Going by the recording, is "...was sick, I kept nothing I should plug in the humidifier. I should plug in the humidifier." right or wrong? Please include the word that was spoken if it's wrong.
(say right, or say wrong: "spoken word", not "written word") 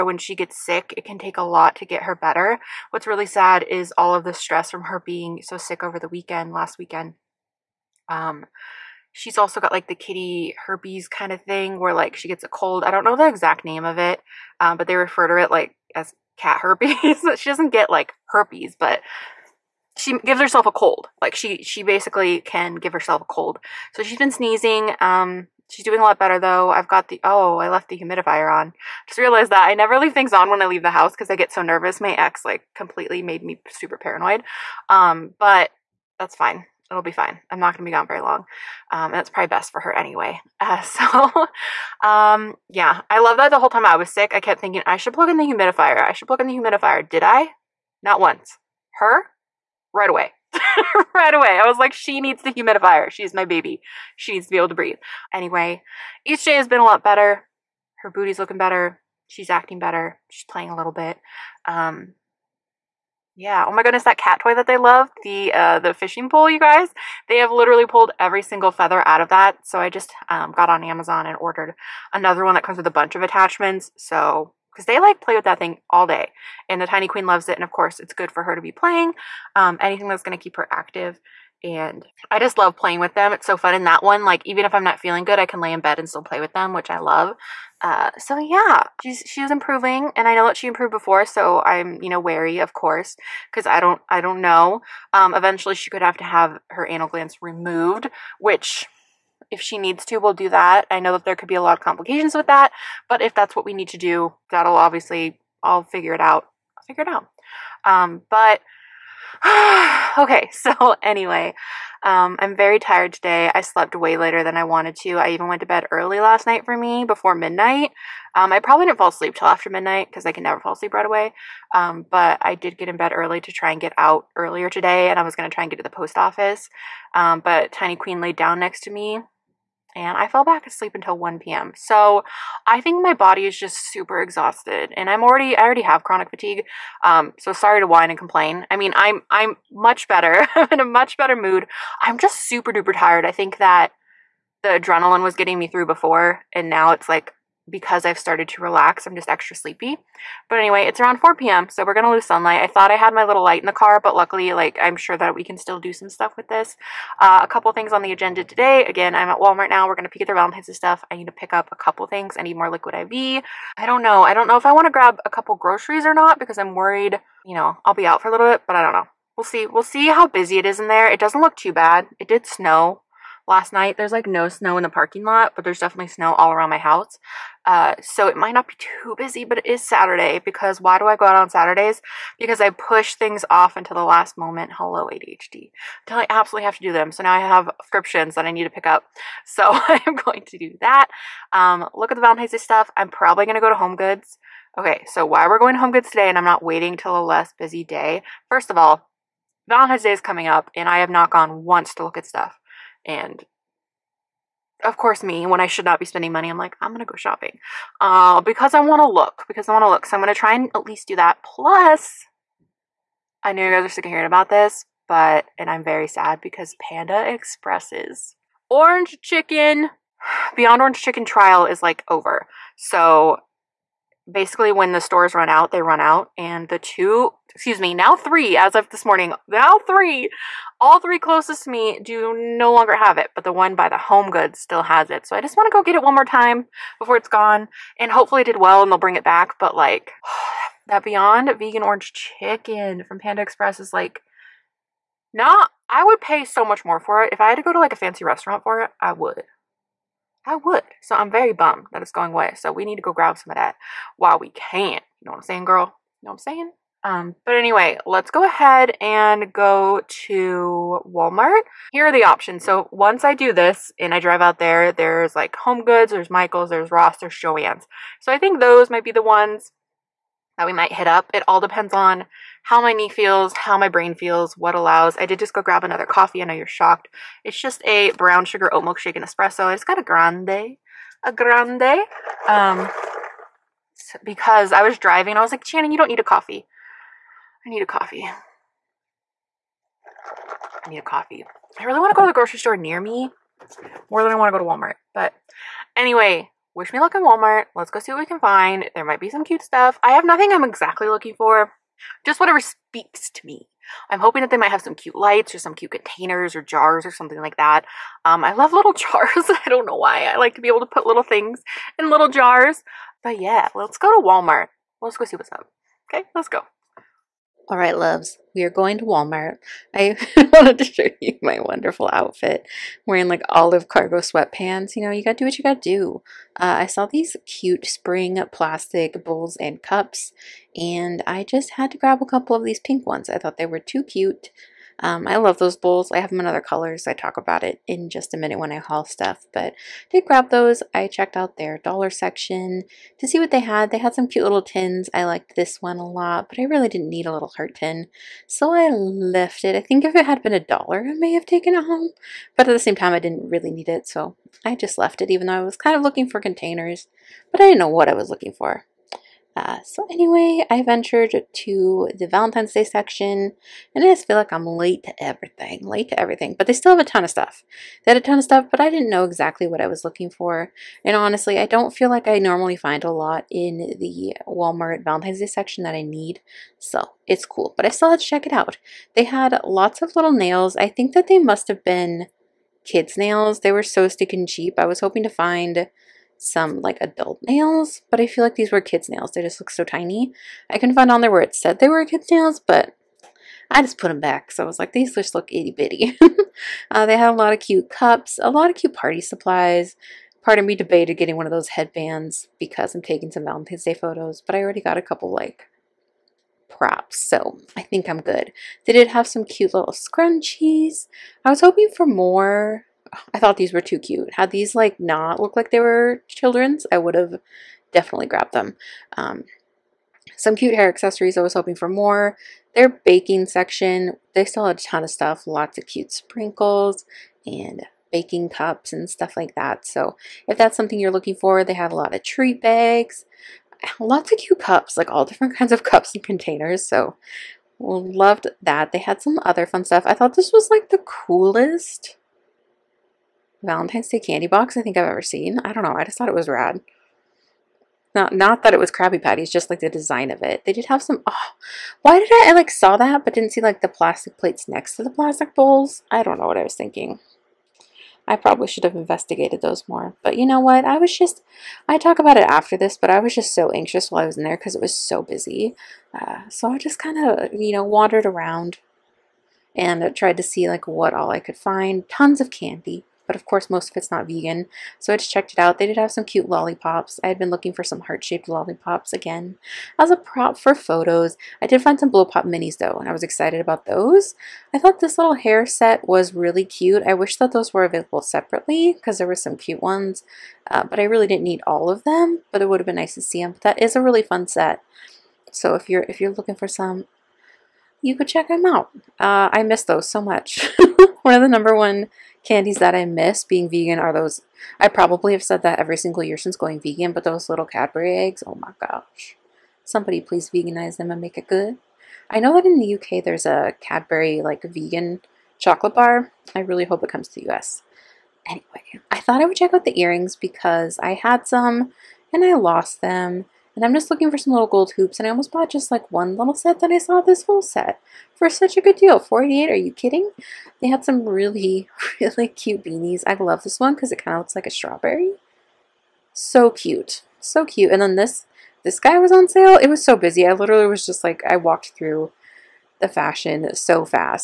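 wrong: "thinking", not "nothing".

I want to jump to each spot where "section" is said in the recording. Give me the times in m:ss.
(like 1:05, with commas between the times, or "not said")
5:42, 6:02, 6:15, 7:03.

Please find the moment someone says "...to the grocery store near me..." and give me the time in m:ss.
4:52.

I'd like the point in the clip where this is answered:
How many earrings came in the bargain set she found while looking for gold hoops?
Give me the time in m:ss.
8:49.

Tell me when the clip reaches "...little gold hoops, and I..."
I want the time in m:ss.
8:44.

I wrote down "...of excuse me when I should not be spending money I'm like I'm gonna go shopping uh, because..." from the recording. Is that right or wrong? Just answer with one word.
wrong.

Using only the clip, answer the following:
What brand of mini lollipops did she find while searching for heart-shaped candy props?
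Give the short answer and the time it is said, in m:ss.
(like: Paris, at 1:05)
Blow Pop, at 8:02.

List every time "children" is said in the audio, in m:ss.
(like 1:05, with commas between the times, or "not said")
6:56.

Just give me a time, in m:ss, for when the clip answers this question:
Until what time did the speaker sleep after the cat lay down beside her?
2:11.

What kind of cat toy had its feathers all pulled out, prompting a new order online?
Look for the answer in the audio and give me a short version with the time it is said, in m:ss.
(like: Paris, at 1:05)
Fishing pole, at 1:05.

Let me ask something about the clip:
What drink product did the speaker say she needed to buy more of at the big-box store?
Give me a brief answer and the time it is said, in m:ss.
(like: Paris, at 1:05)
Liquid IV, at 2:42.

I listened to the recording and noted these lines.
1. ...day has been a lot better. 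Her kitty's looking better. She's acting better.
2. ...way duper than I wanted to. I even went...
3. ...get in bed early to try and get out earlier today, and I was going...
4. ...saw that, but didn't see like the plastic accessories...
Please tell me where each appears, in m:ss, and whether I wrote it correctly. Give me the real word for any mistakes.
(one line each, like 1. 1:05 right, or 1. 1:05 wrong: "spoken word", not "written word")
1. 0:56 wrong: "booty", not "kitty"
2. 1:53 wrong: "later", not "duper"
3. 2:02 right
4. 7:32 wrong: "plates", not "accessories".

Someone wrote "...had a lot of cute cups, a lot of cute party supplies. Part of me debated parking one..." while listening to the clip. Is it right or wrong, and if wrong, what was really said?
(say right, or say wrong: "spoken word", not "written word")
wrong: "getting", not "parking".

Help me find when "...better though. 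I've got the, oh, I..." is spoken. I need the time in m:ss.
0:26.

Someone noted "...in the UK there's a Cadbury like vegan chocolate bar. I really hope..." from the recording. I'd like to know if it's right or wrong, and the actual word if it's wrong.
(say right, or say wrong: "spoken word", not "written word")
right.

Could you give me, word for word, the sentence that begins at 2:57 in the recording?
Uh, so it might not be too busy, but it is Saturday because why do I go out on Saturdays?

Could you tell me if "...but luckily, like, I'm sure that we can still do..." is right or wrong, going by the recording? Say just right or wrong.
right.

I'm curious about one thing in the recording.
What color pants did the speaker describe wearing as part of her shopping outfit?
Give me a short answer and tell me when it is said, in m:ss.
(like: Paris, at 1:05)
Olive, at 5:23.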